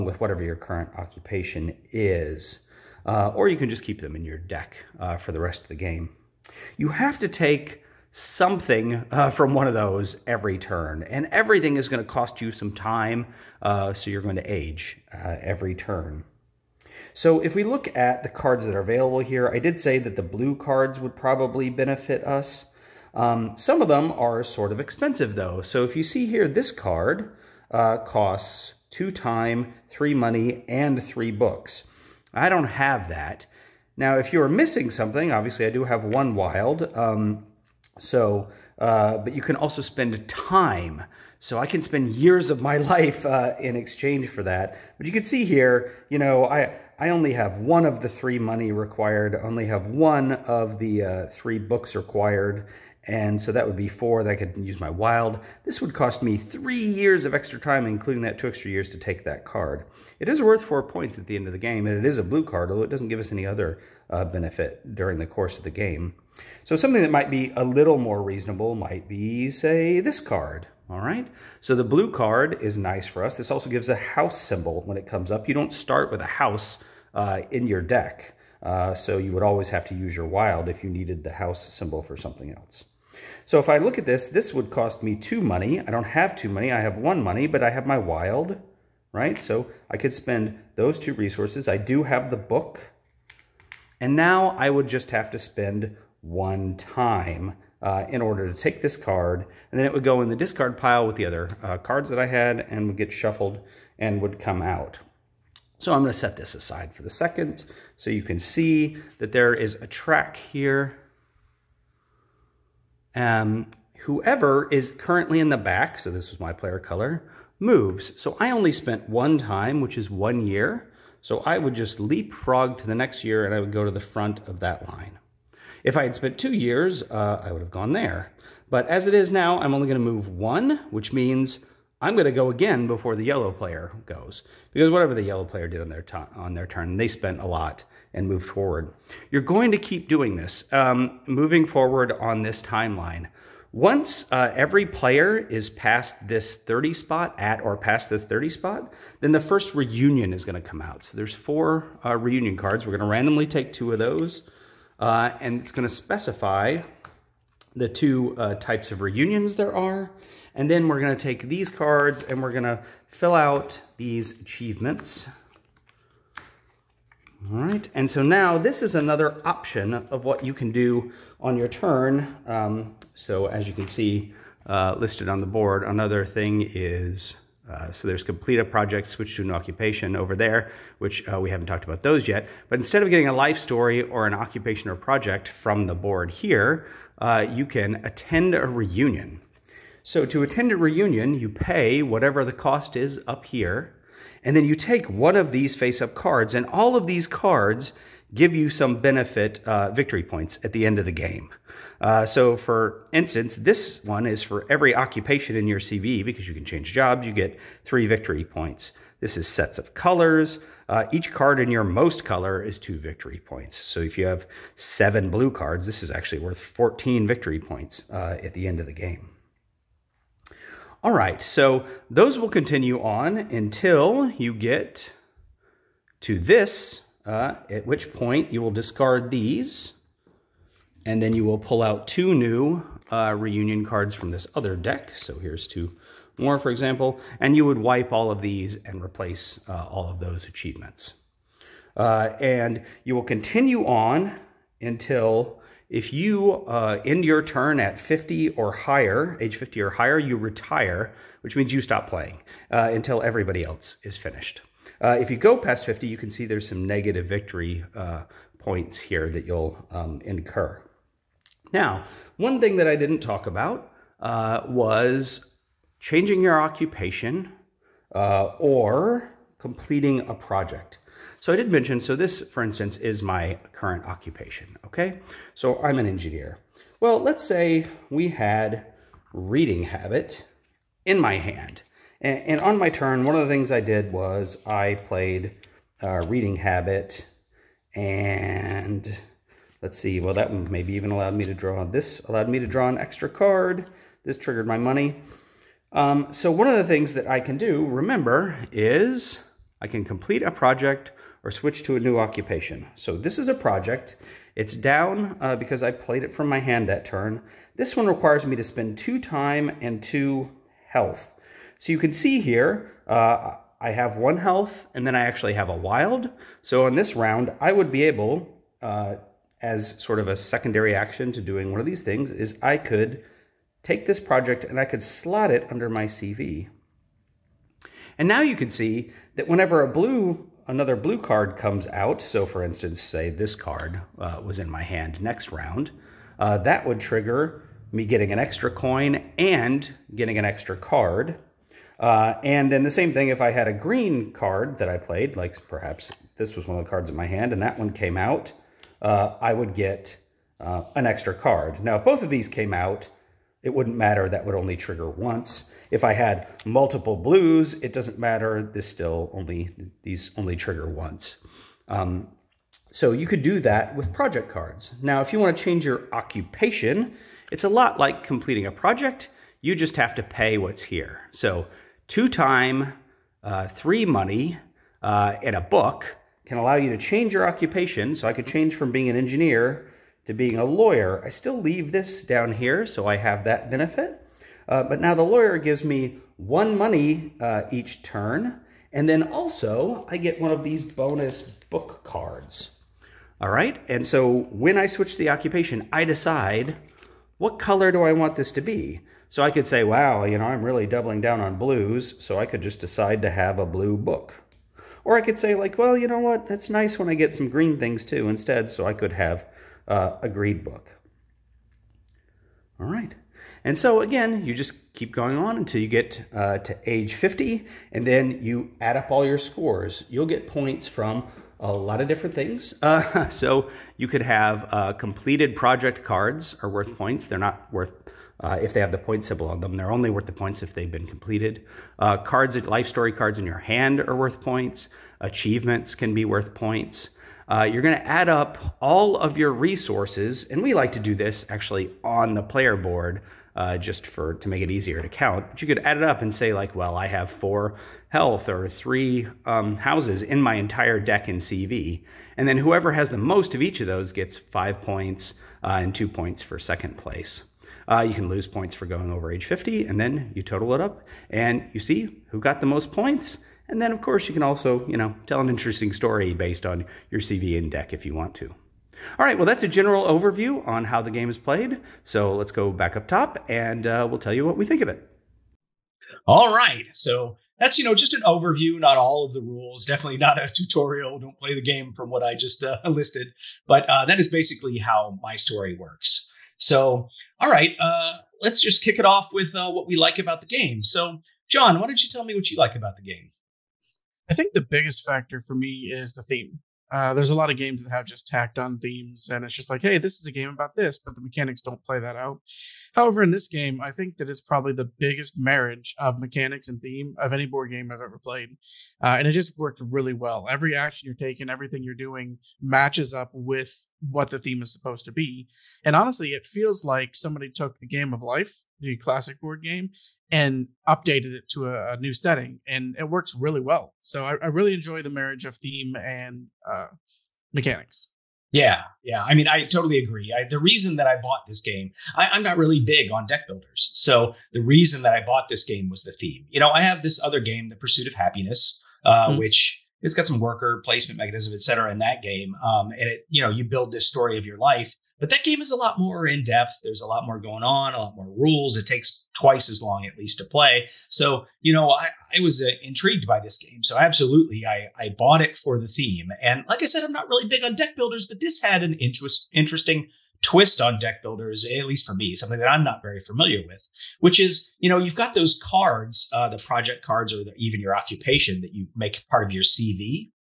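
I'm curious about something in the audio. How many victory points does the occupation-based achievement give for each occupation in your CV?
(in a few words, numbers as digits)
3.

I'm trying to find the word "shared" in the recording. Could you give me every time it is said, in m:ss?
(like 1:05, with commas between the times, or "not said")
not said.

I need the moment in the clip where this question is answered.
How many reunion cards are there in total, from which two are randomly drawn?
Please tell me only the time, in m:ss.
2:31.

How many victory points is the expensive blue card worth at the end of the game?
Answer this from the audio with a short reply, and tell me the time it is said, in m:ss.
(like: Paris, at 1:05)
4, at 1:00.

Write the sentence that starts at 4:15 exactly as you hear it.
Uh, if you go past 50, you can see there's some negative victory uh, points here that you'll um, incur.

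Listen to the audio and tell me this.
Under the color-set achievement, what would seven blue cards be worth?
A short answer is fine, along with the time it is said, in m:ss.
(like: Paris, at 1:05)
14 victory points, at 3:36.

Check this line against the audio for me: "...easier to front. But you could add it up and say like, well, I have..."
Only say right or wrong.
wrong.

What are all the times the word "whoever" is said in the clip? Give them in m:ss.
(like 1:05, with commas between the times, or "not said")
1:54, 7:32.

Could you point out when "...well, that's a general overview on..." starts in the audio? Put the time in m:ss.
7:49.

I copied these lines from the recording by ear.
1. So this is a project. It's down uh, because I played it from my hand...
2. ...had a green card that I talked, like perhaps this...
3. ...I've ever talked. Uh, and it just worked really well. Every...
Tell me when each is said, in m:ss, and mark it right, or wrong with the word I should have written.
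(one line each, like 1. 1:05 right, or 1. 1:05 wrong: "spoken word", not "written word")
1. 5:02 right
2. 5:43 wrong: "played", not "talked"
3. 8:27 wrong: "played", not "talked".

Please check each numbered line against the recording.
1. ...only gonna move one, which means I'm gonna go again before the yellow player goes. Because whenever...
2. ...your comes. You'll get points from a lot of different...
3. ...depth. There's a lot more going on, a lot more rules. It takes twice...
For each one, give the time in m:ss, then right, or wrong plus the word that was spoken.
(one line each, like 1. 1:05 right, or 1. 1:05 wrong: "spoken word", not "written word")
1. 2:09 wrong: "whatever", not "whenever"
2. 6:59 wrong: "scores", not "comes"
3. 9:06 right.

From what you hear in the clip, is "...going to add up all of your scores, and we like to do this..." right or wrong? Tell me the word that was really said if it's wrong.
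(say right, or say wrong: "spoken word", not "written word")
wrong: "resources", not "scores".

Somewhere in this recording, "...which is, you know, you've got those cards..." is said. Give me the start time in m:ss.
9:24.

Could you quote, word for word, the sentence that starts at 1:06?
So something that might be a little more reasonable might be, say, this card.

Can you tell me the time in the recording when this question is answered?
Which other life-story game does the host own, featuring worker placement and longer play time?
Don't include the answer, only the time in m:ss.
8:57.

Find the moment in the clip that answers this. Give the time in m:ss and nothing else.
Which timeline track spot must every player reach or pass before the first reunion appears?
2:26.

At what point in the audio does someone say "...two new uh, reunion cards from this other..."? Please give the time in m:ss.
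3:52.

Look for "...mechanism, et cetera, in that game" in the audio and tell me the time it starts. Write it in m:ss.
9:01.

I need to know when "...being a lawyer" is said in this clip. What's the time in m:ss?
6:20.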